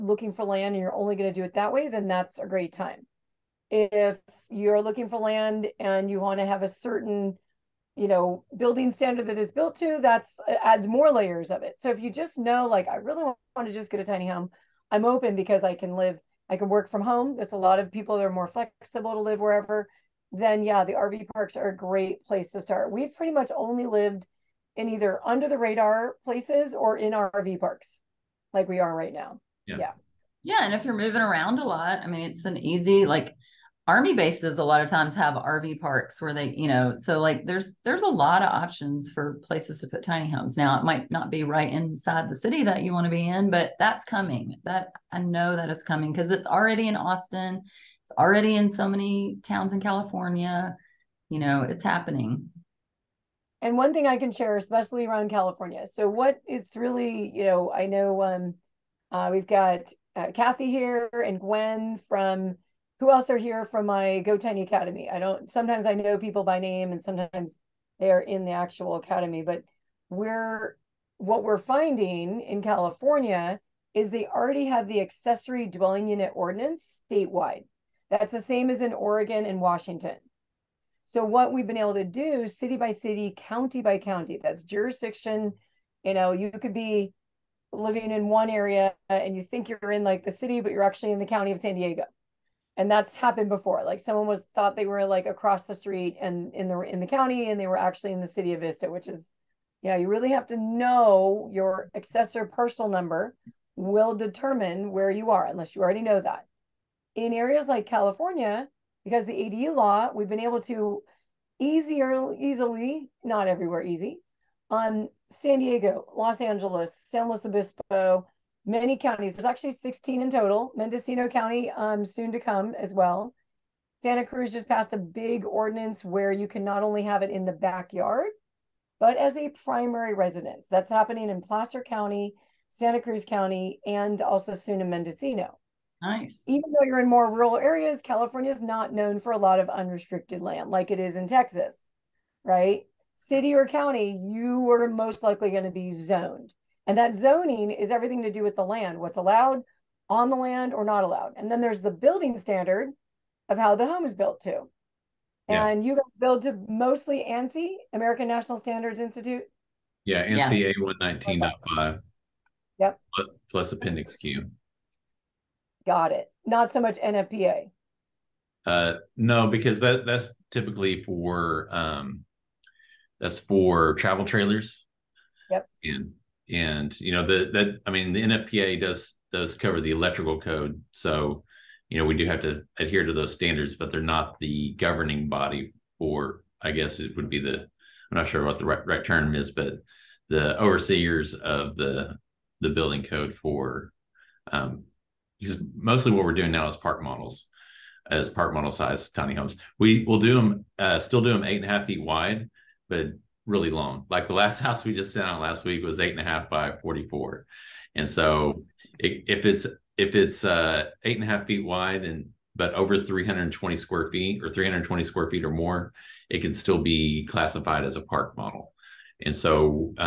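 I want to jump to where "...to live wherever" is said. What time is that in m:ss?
0:19.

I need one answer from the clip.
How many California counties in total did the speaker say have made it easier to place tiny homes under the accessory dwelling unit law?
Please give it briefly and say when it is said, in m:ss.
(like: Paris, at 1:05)
16, at 1:59.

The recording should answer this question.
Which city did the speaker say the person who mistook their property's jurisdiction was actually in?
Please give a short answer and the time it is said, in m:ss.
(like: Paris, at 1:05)
Vista, at 1:38.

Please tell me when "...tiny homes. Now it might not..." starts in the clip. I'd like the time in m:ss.
0:40.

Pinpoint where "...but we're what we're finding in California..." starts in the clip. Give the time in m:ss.
1:09.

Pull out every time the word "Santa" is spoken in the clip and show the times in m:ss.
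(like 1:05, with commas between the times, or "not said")
2:03, 2:12.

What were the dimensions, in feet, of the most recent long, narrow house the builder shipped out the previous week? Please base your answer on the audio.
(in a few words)
8.5 by 44.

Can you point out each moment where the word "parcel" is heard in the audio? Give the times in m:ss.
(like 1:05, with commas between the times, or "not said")
1:42.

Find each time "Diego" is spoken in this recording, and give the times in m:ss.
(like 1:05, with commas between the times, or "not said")
1:31, 1:55.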